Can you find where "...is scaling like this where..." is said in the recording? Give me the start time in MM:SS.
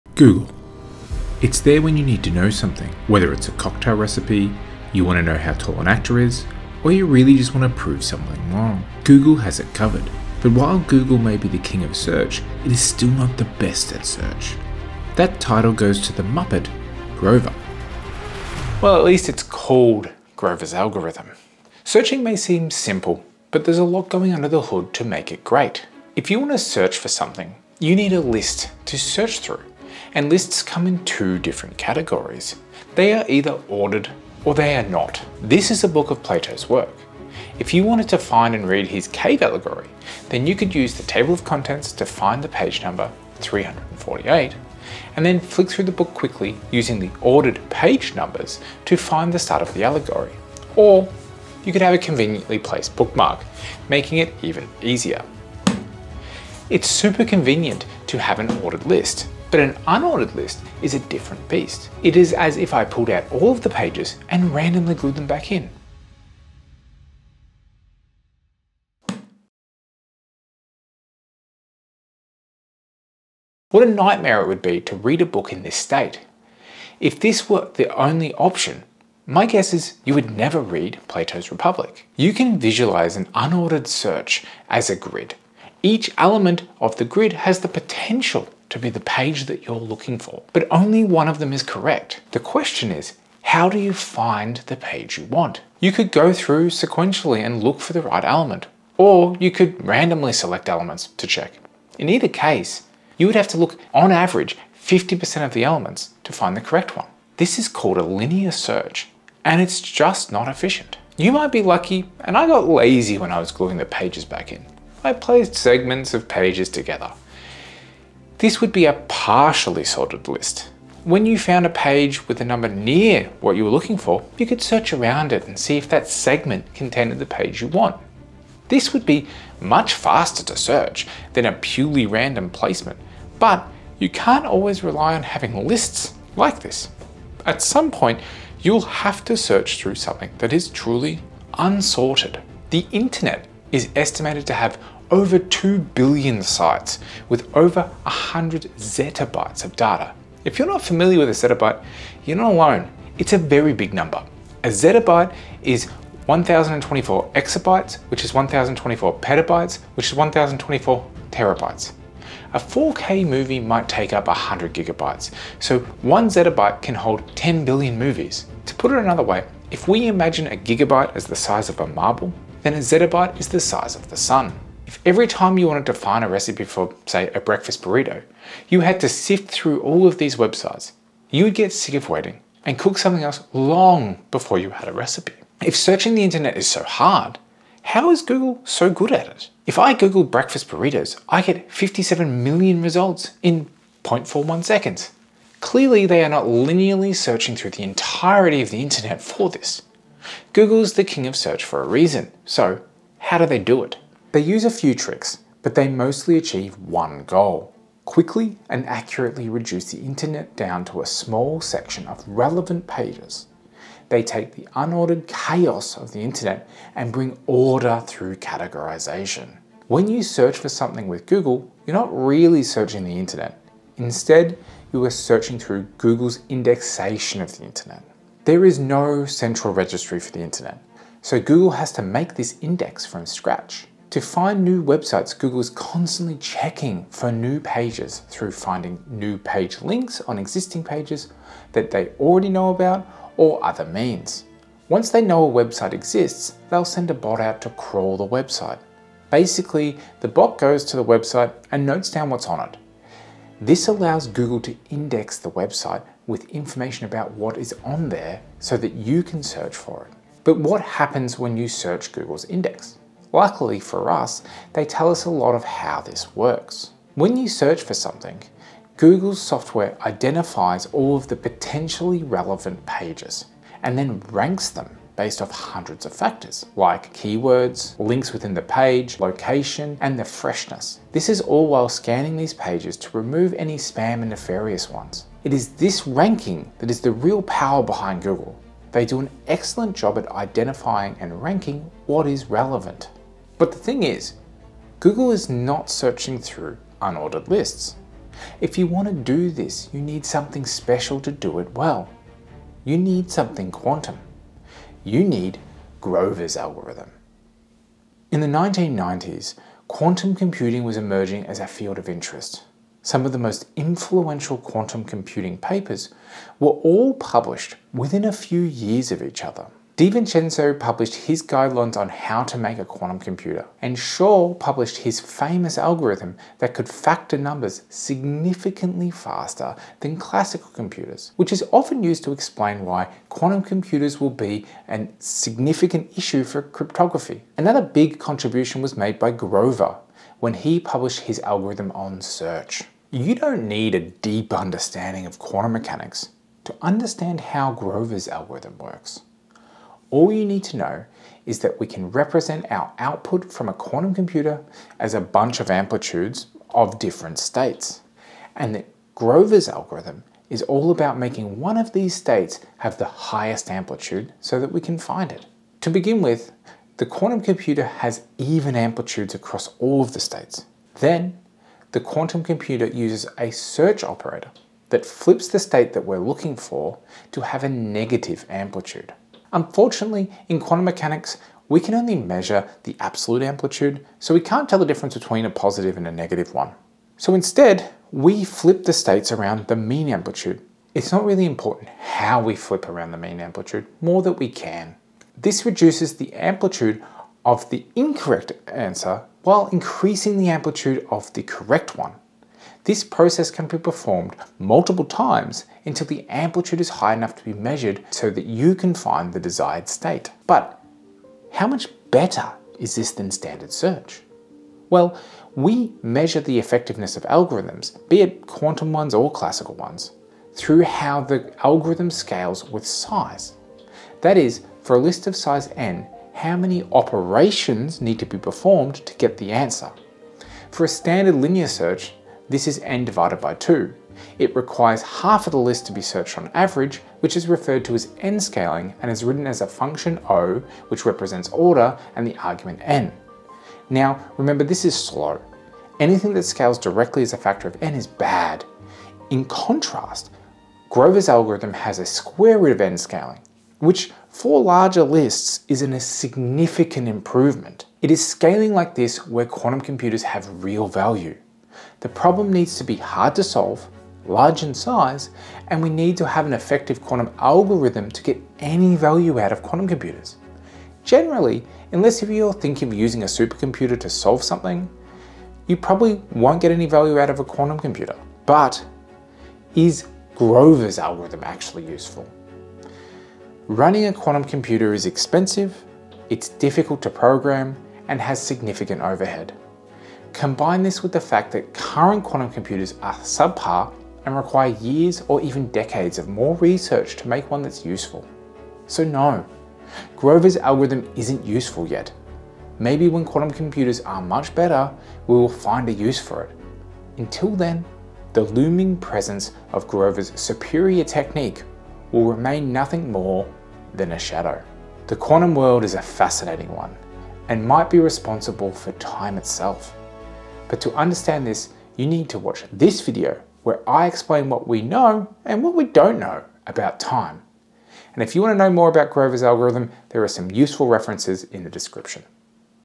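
07:38.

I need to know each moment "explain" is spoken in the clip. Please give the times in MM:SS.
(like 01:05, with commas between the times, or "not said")
05:32, 08:44.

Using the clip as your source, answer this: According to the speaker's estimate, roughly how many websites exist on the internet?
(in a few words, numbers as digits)
over 2 billion.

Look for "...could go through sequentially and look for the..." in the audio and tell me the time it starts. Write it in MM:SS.
01:35.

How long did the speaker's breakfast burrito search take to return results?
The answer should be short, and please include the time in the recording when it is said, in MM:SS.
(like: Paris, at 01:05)
0.41 seconds, at 03:14.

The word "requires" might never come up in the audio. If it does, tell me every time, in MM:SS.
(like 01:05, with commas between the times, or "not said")
07:14, 08:14.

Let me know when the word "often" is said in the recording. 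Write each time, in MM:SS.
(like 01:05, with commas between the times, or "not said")
05:31.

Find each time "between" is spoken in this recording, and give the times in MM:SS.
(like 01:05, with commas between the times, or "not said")
06:25.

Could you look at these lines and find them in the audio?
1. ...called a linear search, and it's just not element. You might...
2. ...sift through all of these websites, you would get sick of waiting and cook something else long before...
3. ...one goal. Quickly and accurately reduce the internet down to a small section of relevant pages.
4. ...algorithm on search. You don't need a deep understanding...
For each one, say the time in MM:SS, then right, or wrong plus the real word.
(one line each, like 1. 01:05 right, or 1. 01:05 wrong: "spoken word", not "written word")
1. 01:47 wrong: "efficient", not "element"
2. 02:59 right
3. 03:26 right
4. 05:41 right.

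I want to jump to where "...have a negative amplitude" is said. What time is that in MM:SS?
06:17.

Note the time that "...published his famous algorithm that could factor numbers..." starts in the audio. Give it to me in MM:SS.
05:24.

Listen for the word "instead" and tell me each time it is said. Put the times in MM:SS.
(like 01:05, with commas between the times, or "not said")
03:43, 06:27.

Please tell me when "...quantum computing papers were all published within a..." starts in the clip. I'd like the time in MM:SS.
05:14.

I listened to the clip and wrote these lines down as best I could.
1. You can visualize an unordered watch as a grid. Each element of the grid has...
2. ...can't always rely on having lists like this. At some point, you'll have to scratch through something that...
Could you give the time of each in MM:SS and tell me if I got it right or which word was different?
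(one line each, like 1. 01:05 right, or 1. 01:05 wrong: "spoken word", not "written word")
1. 01:22 wrong: "search", not "watch"
2. 02:14 wrong: "search", not "scratch".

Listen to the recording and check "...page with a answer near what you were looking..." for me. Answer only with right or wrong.
wrong.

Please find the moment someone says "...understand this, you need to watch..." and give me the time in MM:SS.
08:40.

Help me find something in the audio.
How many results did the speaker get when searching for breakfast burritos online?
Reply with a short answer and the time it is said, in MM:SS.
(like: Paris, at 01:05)
57 million, at 03:11.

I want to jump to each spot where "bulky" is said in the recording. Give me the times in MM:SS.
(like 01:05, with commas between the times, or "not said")
not said.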